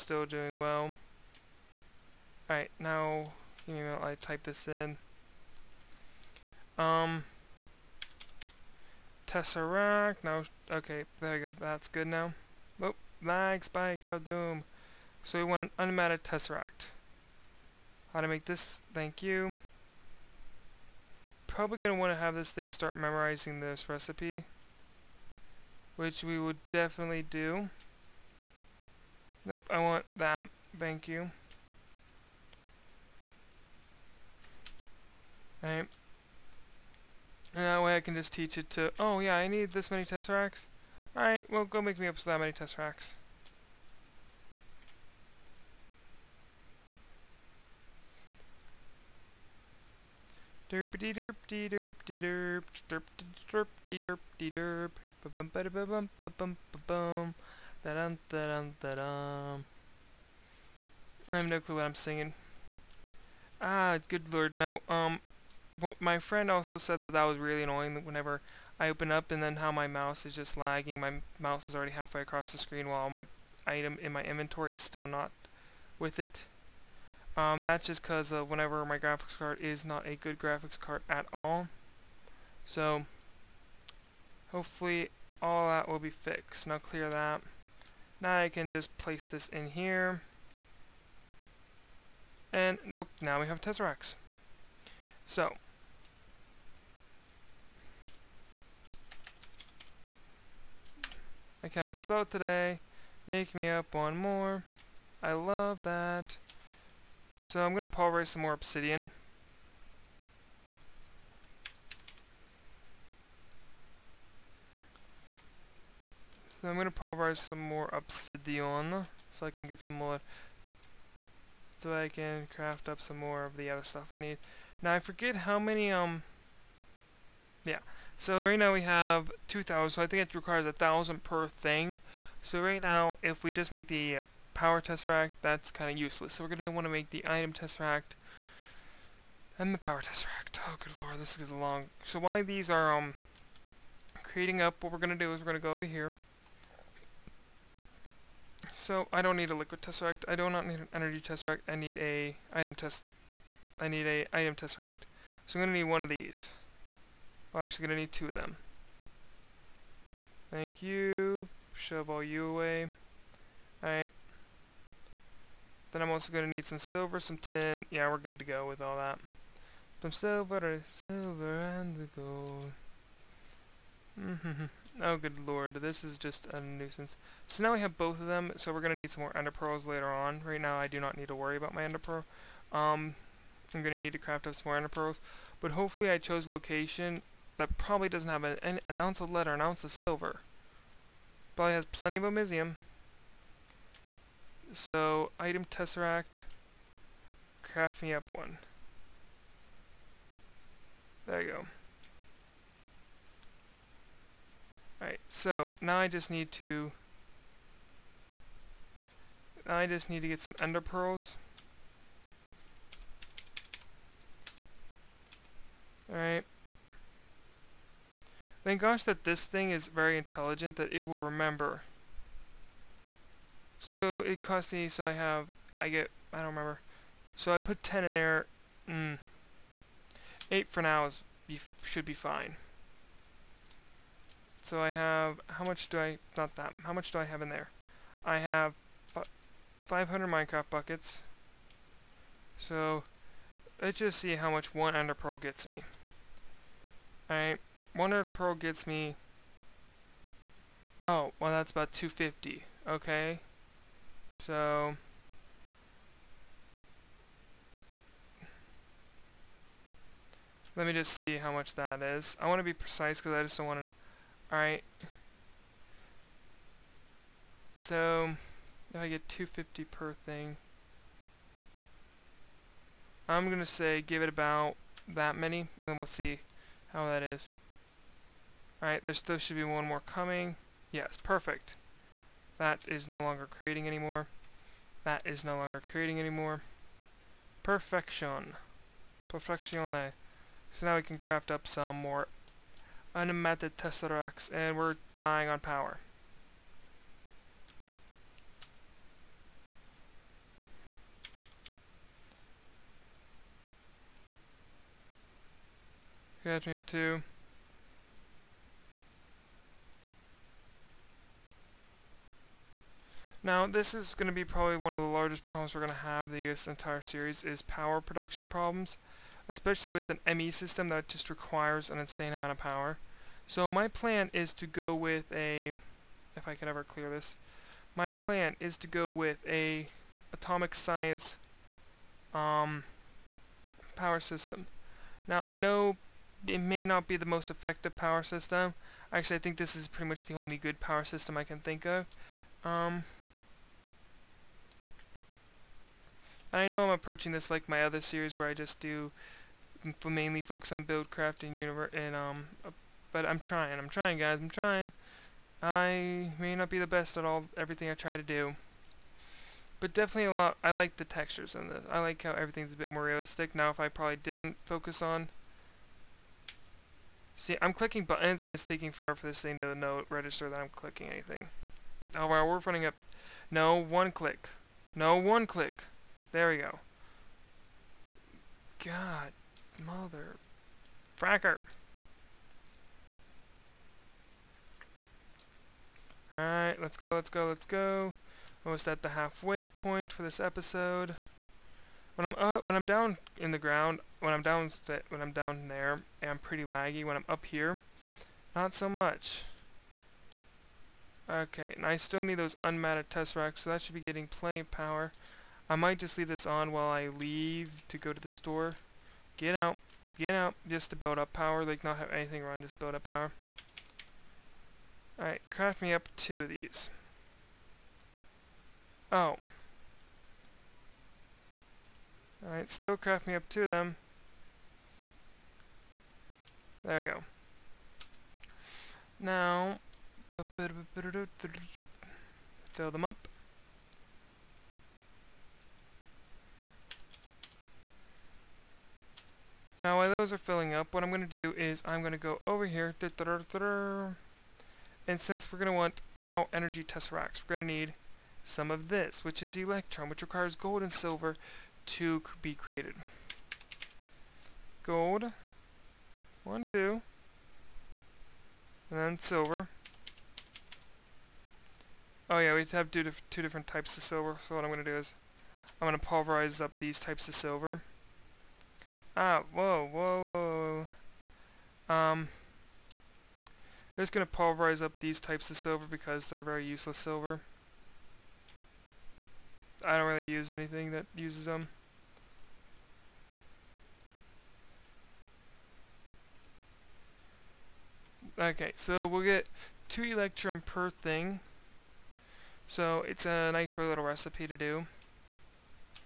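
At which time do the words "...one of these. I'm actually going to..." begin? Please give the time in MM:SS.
02:35.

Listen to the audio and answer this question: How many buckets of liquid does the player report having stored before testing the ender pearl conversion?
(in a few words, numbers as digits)
500.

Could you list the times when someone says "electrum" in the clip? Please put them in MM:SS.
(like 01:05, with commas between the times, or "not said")
07:29, 08:10.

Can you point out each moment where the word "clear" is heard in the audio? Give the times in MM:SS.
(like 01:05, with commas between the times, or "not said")
01:26, 05:26.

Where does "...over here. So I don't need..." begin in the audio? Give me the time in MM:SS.
02:25.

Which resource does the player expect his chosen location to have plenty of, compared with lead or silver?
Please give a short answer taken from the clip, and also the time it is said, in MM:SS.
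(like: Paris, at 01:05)
osmium, at 03:12.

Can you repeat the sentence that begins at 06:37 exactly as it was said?
When I'm up here, not so much.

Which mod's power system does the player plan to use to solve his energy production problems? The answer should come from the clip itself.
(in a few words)
atomic science.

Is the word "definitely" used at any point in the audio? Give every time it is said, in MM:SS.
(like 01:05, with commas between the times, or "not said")
00:26, 05:59.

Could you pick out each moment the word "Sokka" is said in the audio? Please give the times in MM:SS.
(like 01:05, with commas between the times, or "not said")
not said.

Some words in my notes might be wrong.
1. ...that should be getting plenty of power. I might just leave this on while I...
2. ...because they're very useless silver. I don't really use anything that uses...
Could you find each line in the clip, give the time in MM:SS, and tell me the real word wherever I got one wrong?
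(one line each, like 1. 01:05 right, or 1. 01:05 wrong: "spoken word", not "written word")
1. 06:43 right
2. 07:55 right.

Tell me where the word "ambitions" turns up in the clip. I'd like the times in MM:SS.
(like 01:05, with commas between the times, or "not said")
not said.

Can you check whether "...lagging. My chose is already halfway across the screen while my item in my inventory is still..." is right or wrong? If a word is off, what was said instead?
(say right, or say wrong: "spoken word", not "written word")
wrong: "mouse", not "chose".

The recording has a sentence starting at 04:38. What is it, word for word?
Alright, there still should be one more coming.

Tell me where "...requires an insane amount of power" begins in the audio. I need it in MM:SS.
05:21.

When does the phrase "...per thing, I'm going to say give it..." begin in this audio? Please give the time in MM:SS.
04:29.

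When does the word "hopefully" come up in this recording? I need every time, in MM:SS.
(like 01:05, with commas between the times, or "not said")
01:24, 03:05.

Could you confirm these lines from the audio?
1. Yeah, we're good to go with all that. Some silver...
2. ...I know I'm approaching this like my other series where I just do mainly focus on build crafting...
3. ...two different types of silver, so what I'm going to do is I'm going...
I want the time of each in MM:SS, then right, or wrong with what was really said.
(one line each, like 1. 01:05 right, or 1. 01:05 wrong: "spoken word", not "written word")
1. 02:47 right
2. 05:46 right
3. 07:43 right.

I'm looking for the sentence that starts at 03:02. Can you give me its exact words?
Um, I'm going to need to craft up some more ender pearls.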